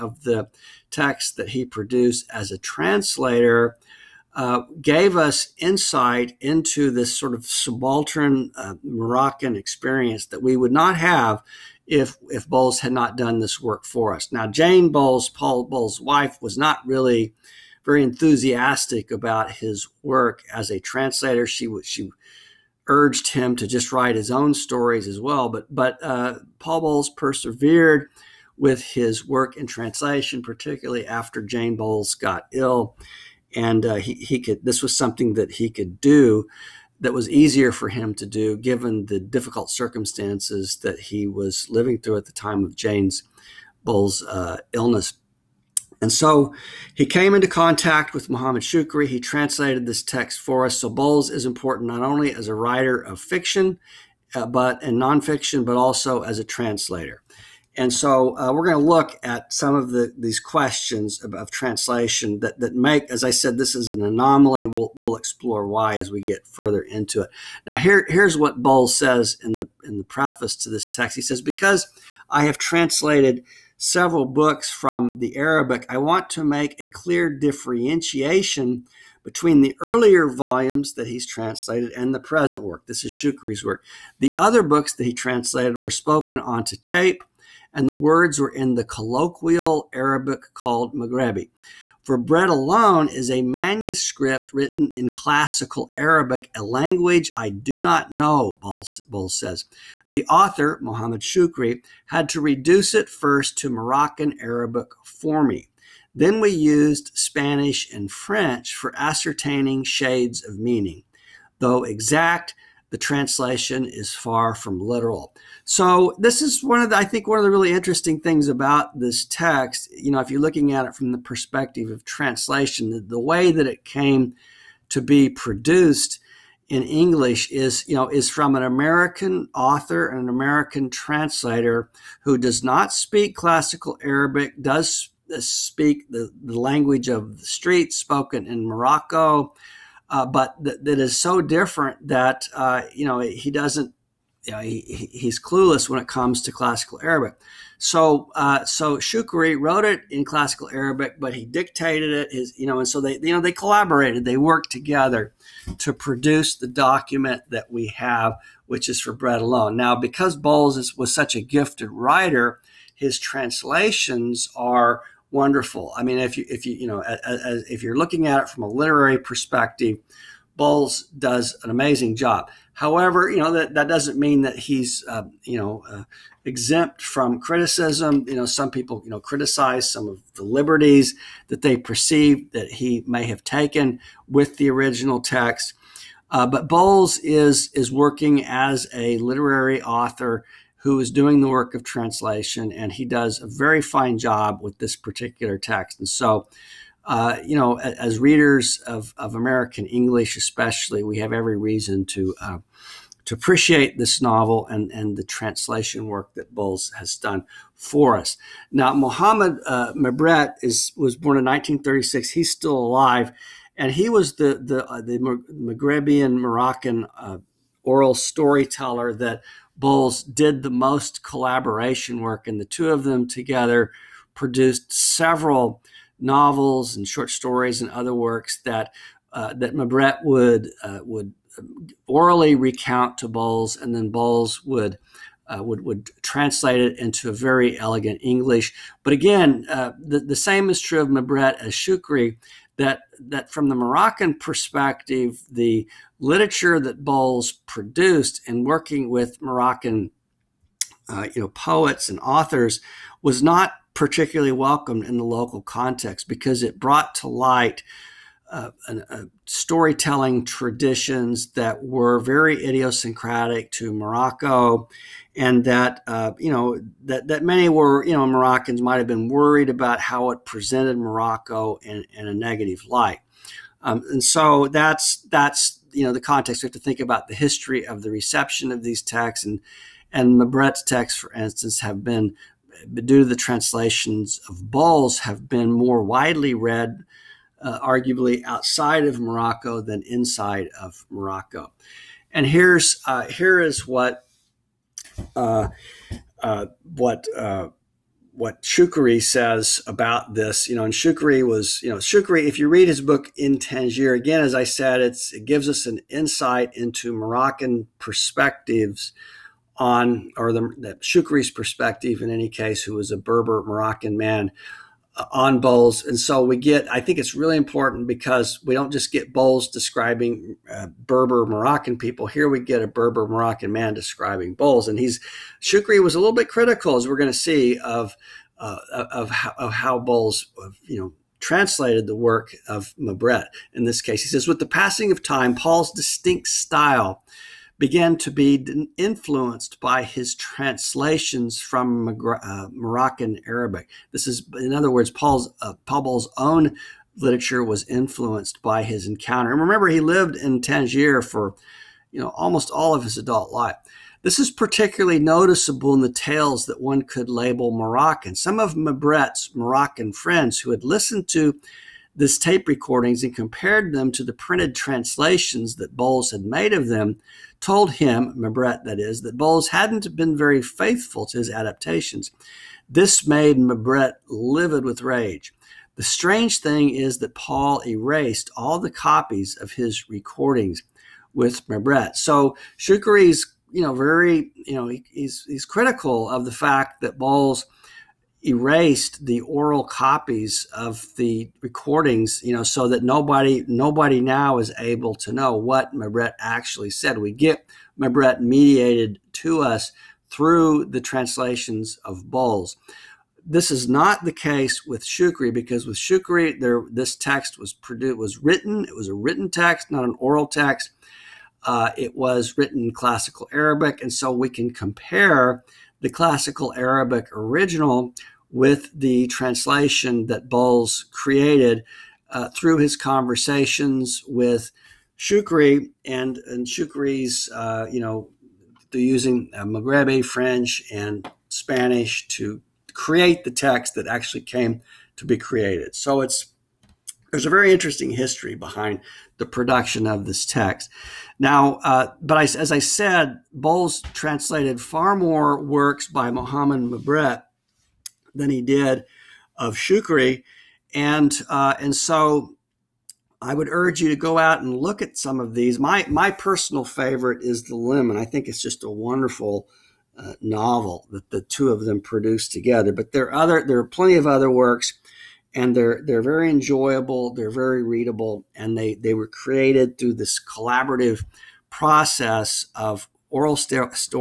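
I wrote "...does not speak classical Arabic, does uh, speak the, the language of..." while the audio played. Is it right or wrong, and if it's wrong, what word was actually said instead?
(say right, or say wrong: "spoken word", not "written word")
right.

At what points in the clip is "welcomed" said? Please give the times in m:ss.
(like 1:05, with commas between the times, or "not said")
4:14.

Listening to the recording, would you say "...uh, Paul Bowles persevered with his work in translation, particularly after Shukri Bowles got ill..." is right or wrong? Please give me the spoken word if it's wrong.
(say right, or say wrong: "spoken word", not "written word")
wrong: "Jane", not "Shukri".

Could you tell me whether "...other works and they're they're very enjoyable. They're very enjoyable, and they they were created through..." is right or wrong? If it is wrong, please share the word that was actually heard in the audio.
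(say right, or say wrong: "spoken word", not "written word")
wrong: "readable", not "enjoyable".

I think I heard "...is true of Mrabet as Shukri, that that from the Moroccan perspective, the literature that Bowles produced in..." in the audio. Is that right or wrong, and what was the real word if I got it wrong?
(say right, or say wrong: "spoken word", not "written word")
right.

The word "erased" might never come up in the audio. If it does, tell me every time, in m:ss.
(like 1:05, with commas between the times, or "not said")
6:17, 6:28.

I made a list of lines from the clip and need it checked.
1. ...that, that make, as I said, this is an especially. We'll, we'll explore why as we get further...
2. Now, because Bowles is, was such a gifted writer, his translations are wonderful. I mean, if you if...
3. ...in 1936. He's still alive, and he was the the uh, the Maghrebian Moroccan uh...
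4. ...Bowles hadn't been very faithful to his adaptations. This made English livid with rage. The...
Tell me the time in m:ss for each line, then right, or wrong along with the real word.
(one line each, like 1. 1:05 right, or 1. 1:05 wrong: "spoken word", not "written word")
1. 1:02 wrong: "anomaly", not "especially"
2. 2:39 right
3. 3:31 right
4. 6:09 wrong: "Mrabet", not "English".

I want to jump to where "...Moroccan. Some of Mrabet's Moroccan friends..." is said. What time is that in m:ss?
5:57.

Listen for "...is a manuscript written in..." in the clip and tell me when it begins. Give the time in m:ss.
1:33.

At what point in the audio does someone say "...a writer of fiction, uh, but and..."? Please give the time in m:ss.
0:52.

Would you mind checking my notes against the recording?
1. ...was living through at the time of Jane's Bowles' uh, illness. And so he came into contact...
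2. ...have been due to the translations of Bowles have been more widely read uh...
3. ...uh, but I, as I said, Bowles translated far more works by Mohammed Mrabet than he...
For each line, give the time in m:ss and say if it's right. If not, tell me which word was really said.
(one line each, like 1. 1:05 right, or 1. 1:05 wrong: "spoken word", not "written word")
1. 0:41 right
2. 4:41 right
3. 7:21 right.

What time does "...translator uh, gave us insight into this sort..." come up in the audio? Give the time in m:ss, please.
0:02.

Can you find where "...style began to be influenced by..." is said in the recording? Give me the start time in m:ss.
5:36.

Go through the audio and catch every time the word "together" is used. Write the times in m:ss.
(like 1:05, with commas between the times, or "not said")
2:34, 3:43, 7:42.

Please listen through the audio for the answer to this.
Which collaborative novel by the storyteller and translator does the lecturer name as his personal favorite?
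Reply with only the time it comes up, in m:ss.
7:37.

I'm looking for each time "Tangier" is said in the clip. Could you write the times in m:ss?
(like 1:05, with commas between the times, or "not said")
5:03, 5:50.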